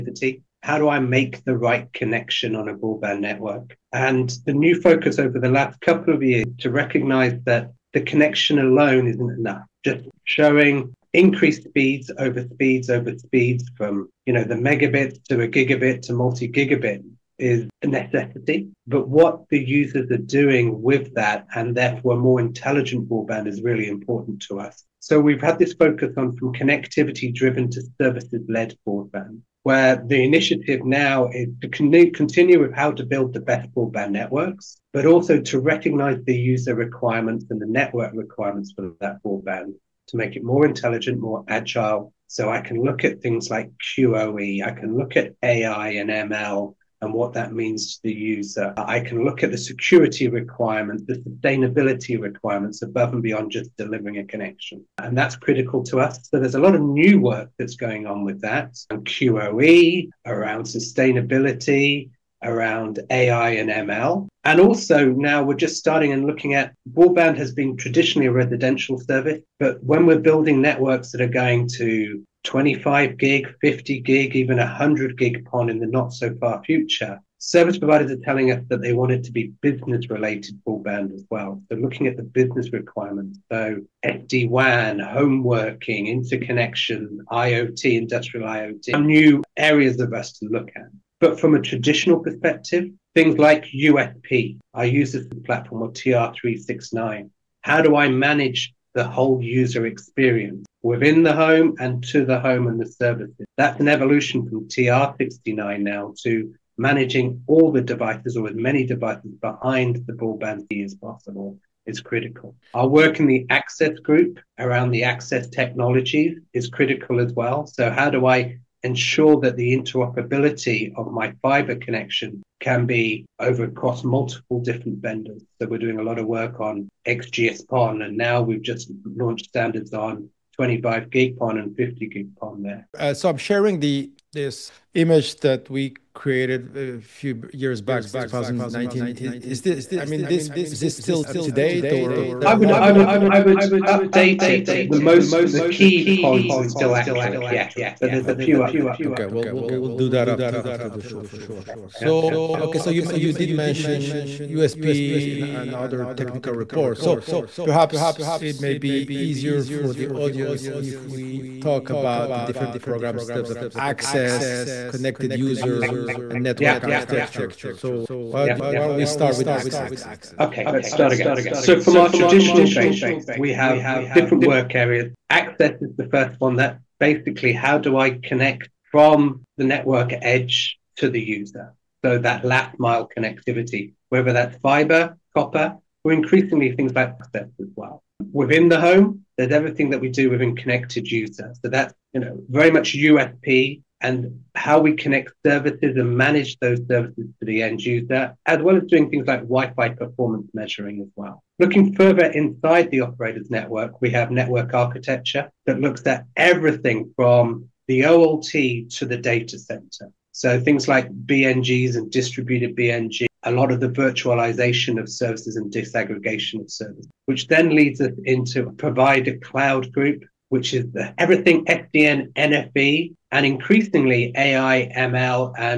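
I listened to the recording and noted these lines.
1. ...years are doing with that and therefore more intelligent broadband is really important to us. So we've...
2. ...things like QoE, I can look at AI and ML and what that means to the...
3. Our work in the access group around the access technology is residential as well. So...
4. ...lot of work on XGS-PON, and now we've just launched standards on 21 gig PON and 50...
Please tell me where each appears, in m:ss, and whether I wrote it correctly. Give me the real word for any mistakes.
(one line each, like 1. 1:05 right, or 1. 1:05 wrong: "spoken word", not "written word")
1. 0:19 wrong: "users", not "years"
2. 0:43 right
3. 1:52 wrong: "critical", not "residential"
4. 2:06 wrong: "25", not "21".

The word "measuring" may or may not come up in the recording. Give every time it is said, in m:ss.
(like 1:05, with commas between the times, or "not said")
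3:20.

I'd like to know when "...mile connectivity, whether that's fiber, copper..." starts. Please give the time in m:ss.
3:02.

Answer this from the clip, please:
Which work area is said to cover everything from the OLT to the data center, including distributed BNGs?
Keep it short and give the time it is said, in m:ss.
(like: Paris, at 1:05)
Network architecture, at 3:24.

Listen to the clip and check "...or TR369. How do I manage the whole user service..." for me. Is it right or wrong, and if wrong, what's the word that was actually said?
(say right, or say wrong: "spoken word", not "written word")
wrong: "experience", not "service".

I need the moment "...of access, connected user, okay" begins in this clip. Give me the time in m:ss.
2:43.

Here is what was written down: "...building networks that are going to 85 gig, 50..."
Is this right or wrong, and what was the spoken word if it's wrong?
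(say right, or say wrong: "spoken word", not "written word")
wrong: "25", not "85".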